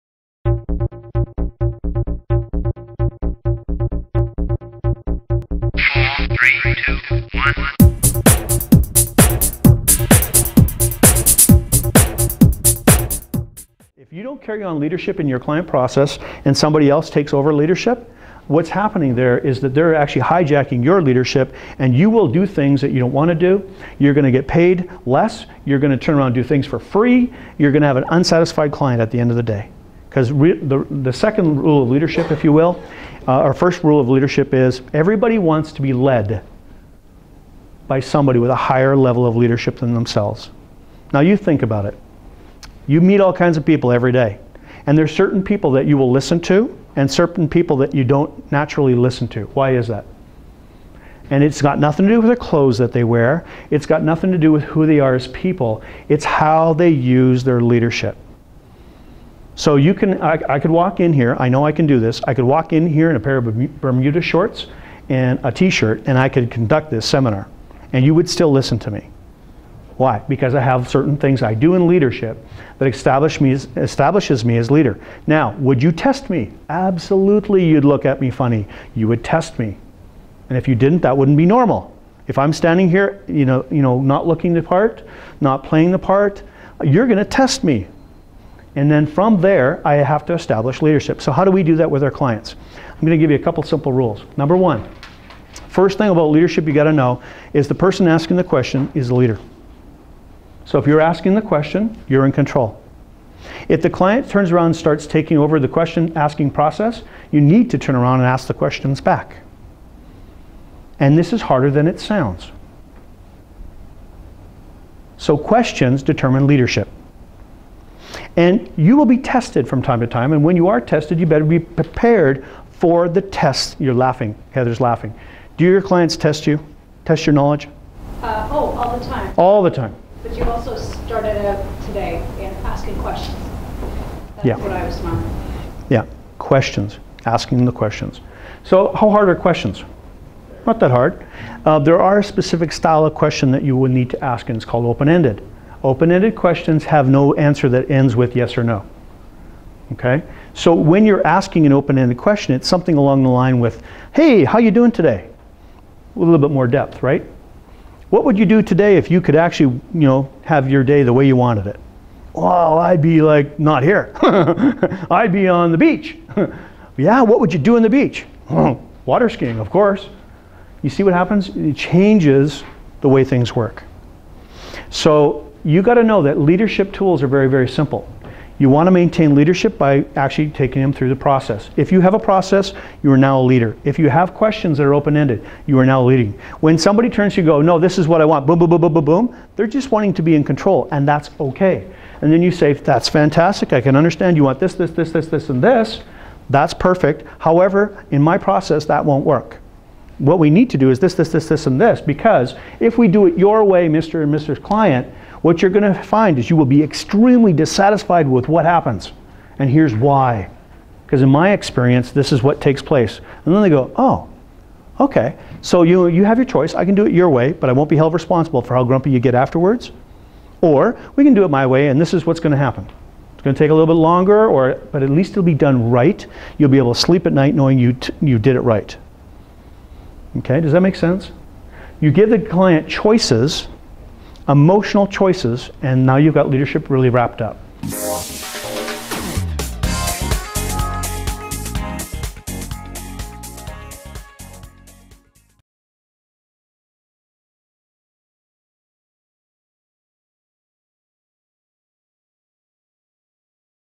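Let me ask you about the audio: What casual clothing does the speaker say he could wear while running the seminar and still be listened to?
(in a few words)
Bermuda shorts.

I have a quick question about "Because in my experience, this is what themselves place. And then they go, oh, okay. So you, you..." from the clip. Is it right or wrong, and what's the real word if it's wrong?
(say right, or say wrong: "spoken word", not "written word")
wrong: "takes", not "themselves".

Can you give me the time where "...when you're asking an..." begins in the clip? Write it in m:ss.
2:30.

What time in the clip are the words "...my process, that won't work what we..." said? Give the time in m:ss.
3:18.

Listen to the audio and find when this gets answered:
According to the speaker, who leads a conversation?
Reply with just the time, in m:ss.
1:37.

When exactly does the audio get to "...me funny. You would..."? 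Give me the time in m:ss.
1:18.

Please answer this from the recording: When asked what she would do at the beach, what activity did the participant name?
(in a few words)
Water skiing.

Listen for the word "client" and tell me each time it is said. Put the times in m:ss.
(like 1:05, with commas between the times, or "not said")
0:15, 0:28, 1:32, 1:43, 2:05, 3:24, 3:52.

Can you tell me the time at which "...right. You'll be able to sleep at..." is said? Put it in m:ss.
3:45.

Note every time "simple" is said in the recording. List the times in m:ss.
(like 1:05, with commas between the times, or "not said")
1:33, 2:57.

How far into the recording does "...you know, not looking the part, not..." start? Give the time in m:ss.
1:23.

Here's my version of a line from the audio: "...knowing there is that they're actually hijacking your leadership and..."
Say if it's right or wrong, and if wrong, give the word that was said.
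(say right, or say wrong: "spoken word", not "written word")
wrong: "happening", not "knowing".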